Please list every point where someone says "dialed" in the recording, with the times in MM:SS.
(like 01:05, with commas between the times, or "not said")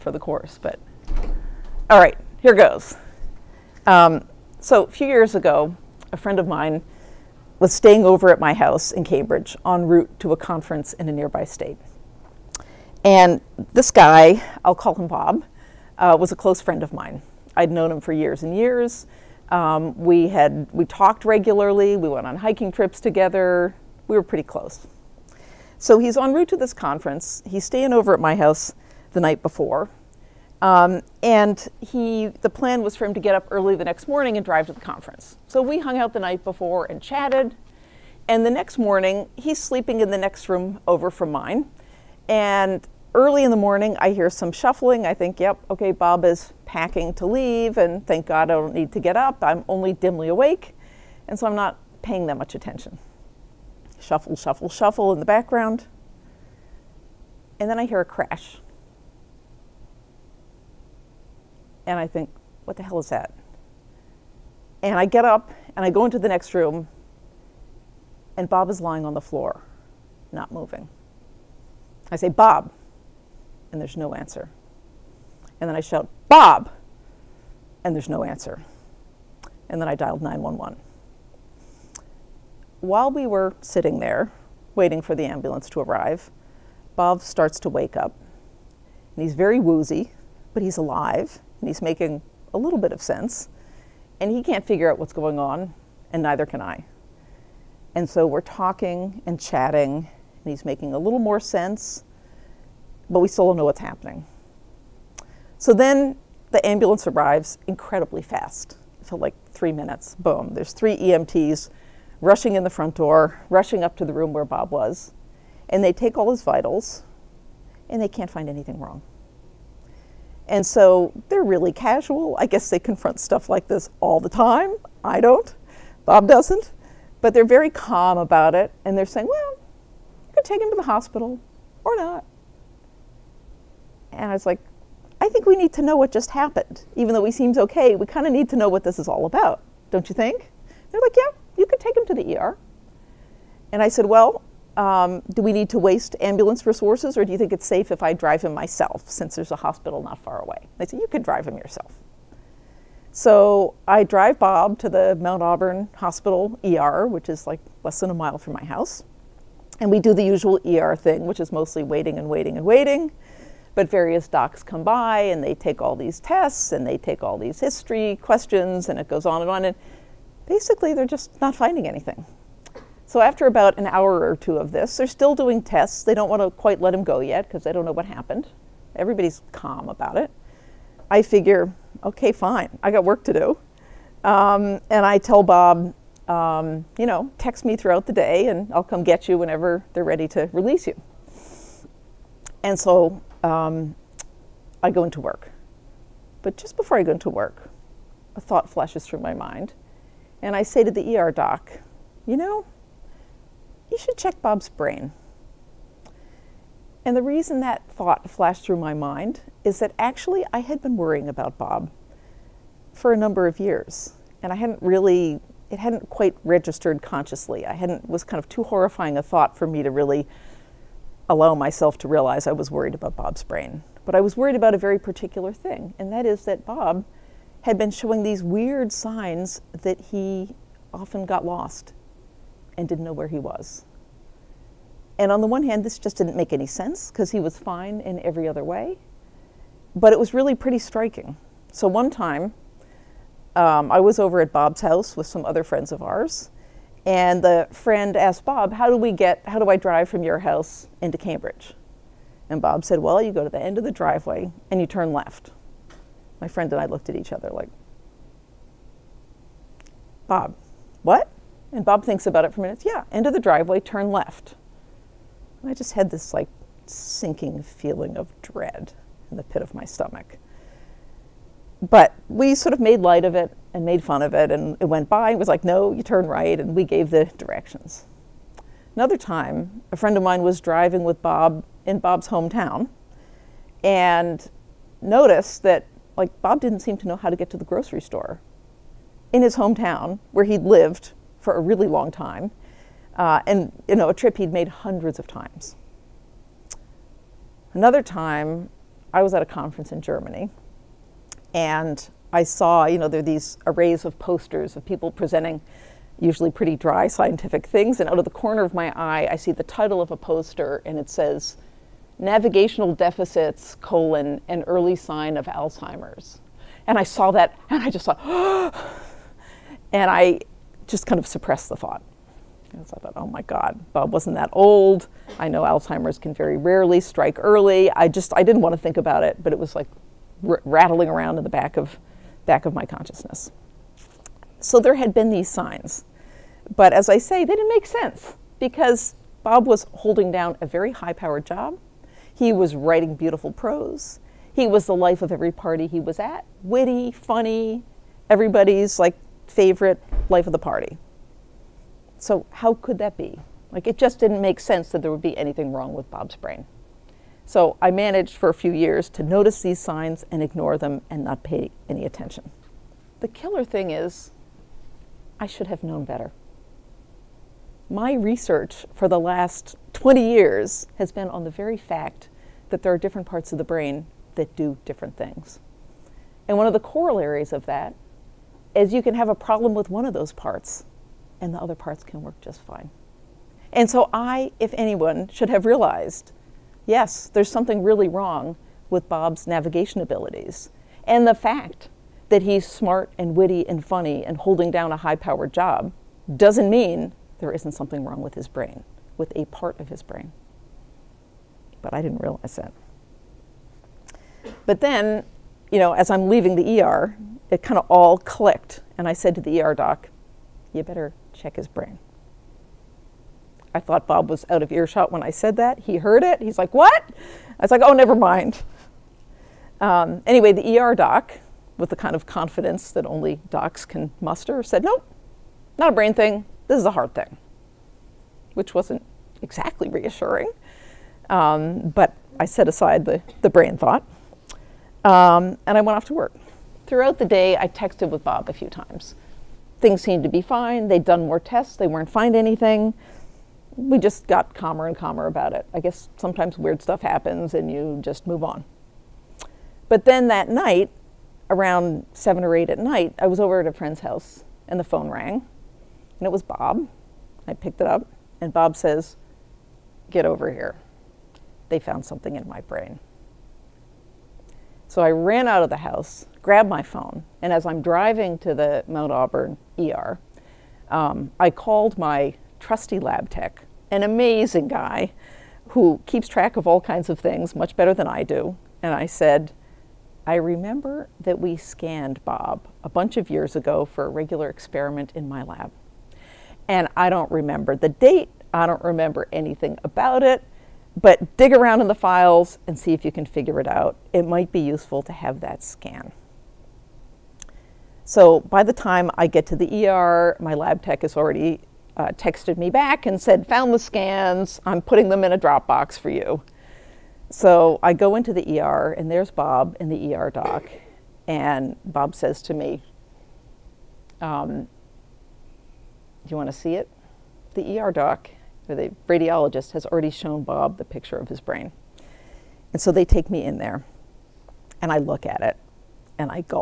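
01:19.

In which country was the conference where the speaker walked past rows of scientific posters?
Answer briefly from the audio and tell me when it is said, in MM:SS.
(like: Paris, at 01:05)
Germany, at 05:00.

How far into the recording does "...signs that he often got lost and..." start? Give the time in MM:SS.
03:48.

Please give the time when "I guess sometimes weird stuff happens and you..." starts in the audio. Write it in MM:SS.
07:25.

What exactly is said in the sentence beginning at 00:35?
So we hung out the night before and chatted.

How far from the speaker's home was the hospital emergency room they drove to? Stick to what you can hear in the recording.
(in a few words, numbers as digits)
less than a mile.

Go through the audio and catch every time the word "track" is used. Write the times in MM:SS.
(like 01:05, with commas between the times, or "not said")
07:56.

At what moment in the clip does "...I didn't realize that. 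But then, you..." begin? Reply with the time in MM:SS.
06:41.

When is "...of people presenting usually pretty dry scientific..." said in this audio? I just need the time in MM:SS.
05:04.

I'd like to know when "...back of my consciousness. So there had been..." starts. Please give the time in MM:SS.
05:32.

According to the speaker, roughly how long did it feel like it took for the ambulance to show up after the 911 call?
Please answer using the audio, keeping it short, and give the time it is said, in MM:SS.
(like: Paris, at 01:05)
3 minutes, at 01:49.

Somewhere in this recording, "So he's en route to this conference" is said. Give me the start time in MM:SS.
00:25.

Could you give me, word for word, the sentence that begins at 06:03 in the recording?
The killer thing is, I should have known better.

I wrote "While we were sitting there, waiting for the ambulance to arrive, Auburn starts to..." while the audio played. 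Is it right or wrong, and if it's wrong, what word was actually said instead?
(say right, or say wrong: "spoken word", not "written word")
wrong: "Bob", not "Auburn".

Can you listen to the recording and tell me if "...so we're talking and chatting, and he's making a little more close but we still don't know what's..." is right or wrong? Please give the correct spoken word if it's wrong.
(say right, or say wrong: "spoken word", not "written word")
wrong: "sense", not "close".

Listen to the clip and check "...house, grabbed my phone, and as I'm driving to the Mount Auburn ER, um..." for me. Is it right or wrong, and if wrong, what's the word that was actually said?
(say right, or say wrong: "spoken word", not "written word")
right.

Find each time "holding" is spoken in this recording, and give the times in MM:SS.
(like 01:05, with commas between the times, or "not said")
05:39, 06:34.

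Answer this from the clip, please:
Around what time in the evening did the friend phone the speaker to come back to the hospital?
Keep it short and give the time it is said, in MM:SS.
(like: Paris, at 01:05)
7 or 8, at 07:32.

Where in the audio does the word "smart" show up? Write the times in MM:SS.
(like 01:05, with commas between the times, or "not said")
06:32.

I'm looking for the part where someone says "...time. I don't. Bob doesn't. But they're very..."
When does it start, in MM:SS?
02:04.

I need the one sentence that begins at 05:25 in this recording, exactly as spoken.
I know Alzheimer's can very rarely strike early.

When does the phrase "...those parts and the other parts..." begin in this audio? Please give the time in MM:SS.
06:20.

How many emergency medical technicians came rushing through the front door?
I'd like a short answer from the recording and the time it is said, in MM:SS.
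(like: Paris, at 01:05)
3, at 01:50.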